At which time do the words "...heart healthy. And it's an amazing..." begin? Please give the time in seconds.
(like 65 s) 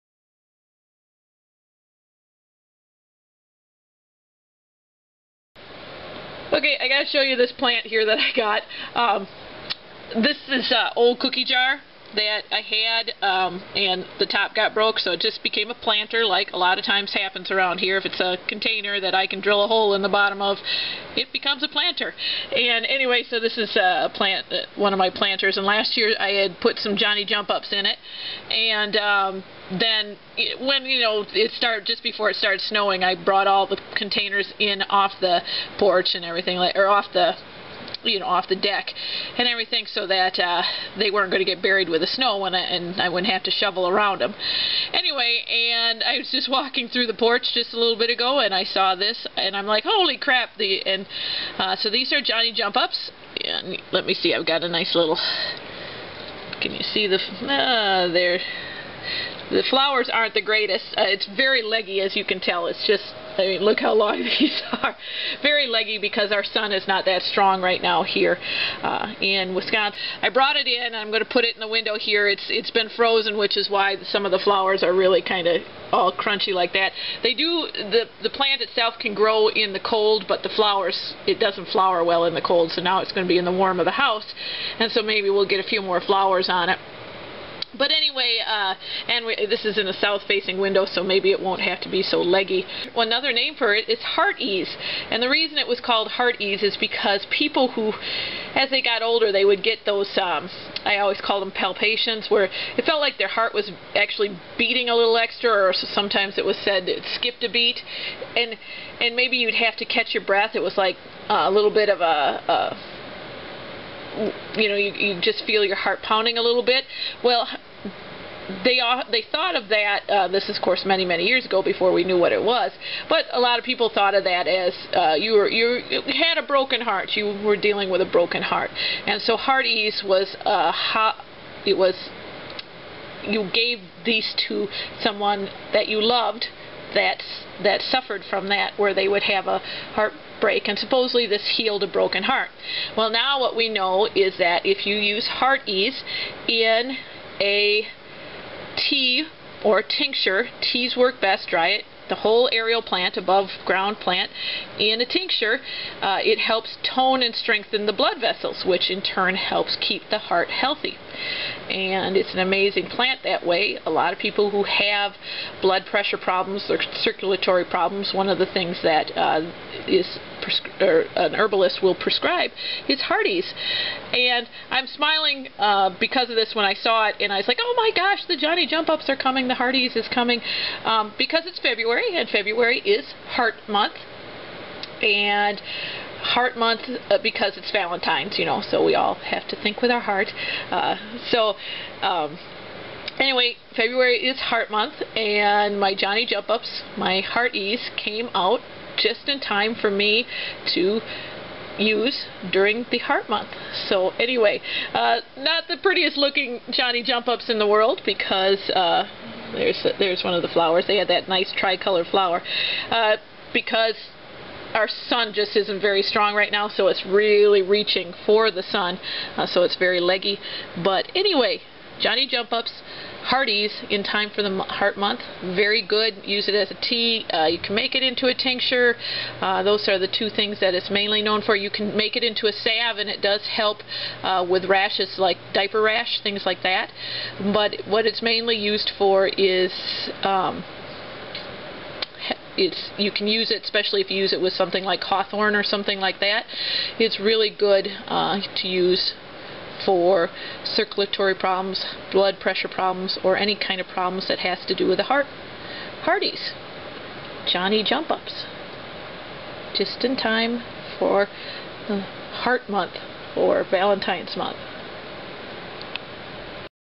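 160 s.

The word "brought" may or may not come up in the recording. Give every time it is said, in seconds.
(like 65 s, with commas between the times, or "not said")
33 s, 70 s.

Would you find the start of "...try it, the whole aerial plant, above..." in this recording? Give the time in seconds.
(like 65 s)
151 s.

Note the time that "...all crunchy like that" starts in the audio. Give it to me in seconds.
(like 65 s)
75 s.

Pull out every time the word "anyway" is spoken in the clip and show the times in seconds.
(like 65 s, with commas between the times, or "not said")
22 s, 44 s, 87 s, 193 s, 204 s, 221 s.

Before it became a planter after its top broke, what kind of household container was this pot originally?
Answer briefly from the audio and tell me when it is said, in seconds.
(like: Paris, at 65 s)
Cookie jar, at 11 s.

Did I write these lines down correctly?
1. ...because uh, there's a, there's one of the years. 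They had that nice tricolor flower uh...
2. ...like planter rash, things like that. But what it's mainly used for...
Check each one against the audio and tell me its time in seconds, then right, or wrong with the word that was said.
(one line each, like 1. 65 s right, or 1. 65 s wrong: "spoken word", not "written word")
1. 208 s wrong: "flowers", not "years"
2. 235 s wrong: "diaper", not "planter".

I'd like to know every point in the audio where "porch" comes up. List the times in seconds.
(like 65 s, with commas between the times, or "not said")
35 s, 47 s.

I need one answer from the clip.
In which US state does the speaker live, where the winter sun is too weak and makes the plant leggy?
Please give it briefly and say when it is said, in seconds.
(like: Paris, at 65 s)
Wisconsin, at 69 s.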